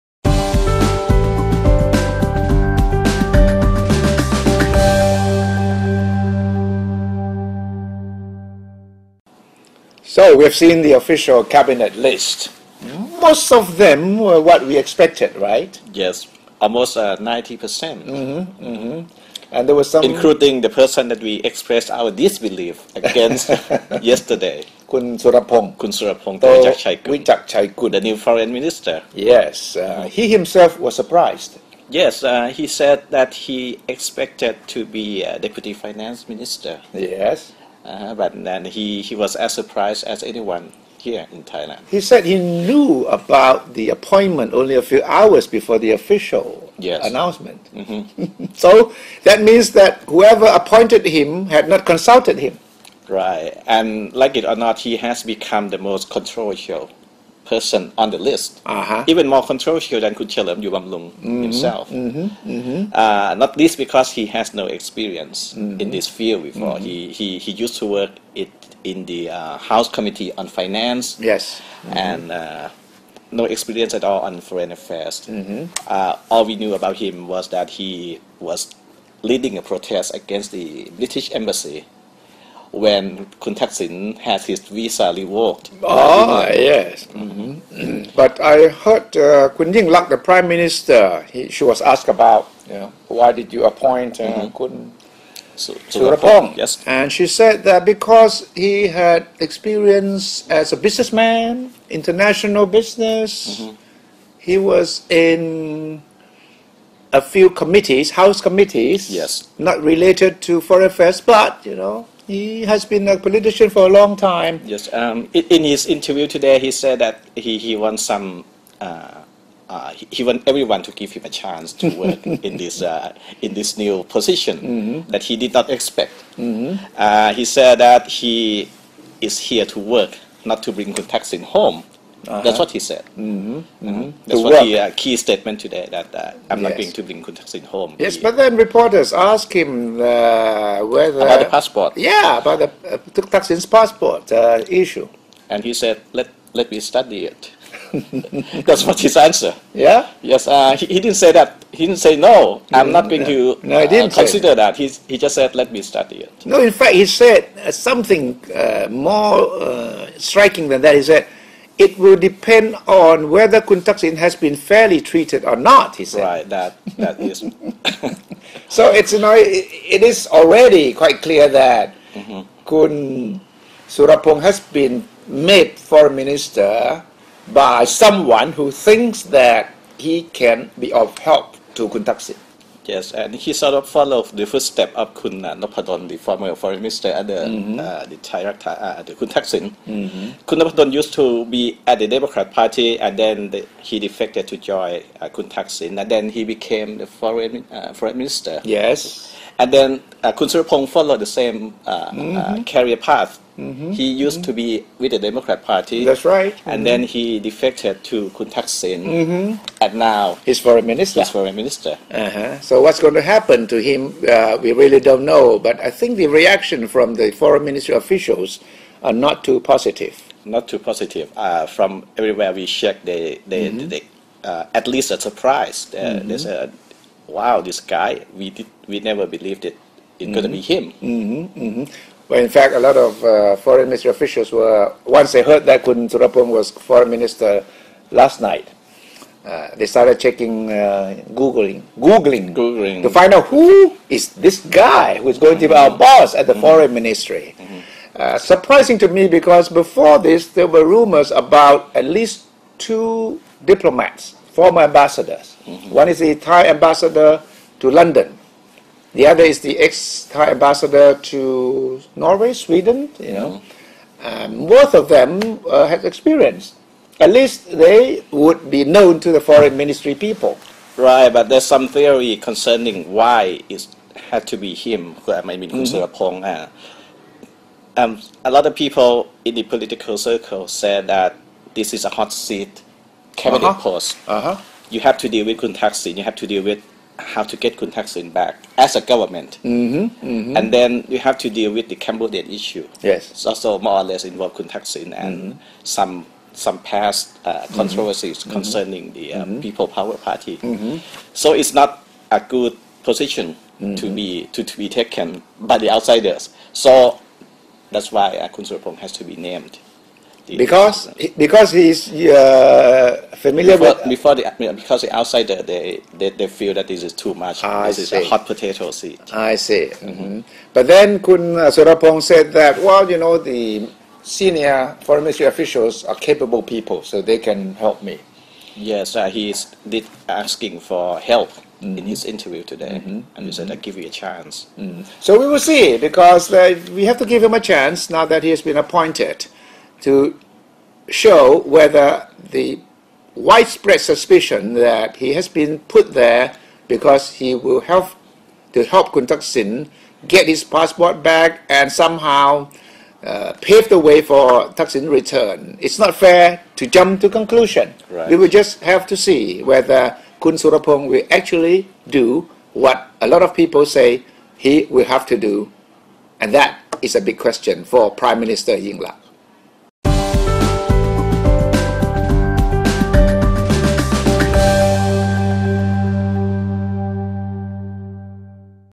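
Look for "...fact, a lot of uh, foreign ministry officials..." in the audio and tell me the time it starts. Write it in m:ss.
3:52.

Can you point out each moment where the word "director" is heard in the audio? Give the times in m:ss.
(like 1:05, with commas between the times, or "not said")
3:08.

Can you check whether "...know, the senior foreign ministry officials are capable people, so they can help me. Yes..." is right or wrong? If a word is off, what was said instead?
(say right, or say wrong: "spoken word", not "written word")
right.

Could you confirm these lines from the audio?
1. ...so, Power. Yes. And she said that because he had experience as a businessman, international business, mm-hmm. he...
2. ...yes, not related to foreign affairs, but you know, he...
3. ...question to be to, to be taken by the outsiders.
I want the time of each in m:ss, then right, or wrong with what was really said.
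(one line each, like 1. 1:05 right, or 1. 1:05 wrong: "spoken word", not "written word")
1. 1:35 wrong: "Surapong", not "Power"
2. 1:49 right
3. 5:03 wrong: "position", not "question".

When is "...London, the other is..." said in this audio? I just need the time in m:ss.
4:17.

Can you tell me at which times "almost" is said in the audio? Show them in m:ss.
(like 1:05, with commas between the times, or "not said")
0:16.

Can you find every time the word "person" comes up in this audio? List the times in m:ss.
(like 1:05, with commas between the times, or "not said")
0:20, 0:57.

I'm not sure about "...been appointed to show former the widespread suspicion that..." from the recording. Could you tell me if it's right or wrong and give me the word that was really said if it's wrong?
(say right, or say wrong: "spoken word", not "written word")
wrong: "whether", not "former".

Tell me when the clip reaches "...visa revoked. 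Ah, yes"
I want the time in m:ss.
1:24.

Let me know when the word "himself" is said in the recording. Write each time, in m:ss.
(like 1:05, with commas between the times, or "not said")
0:30, 1:01.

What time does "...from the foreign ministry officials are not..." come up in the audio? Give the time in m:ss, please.
3:36.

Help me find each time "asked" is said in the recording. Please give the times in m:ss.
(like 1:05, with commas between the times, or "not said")
1:31, 2:19.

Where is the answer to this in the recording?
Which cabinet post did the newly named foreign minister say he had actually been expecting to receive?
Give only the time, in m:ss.
0:35.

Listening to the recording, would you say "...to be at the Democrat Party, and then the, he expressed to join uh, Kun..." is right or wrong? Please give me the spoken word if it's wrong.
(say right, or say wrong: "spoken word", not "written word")
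wrong: "defected", not "expressed".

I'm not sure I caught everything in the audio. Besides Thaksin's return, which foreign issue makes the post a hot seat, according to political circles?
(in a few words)
The Cambodian issue.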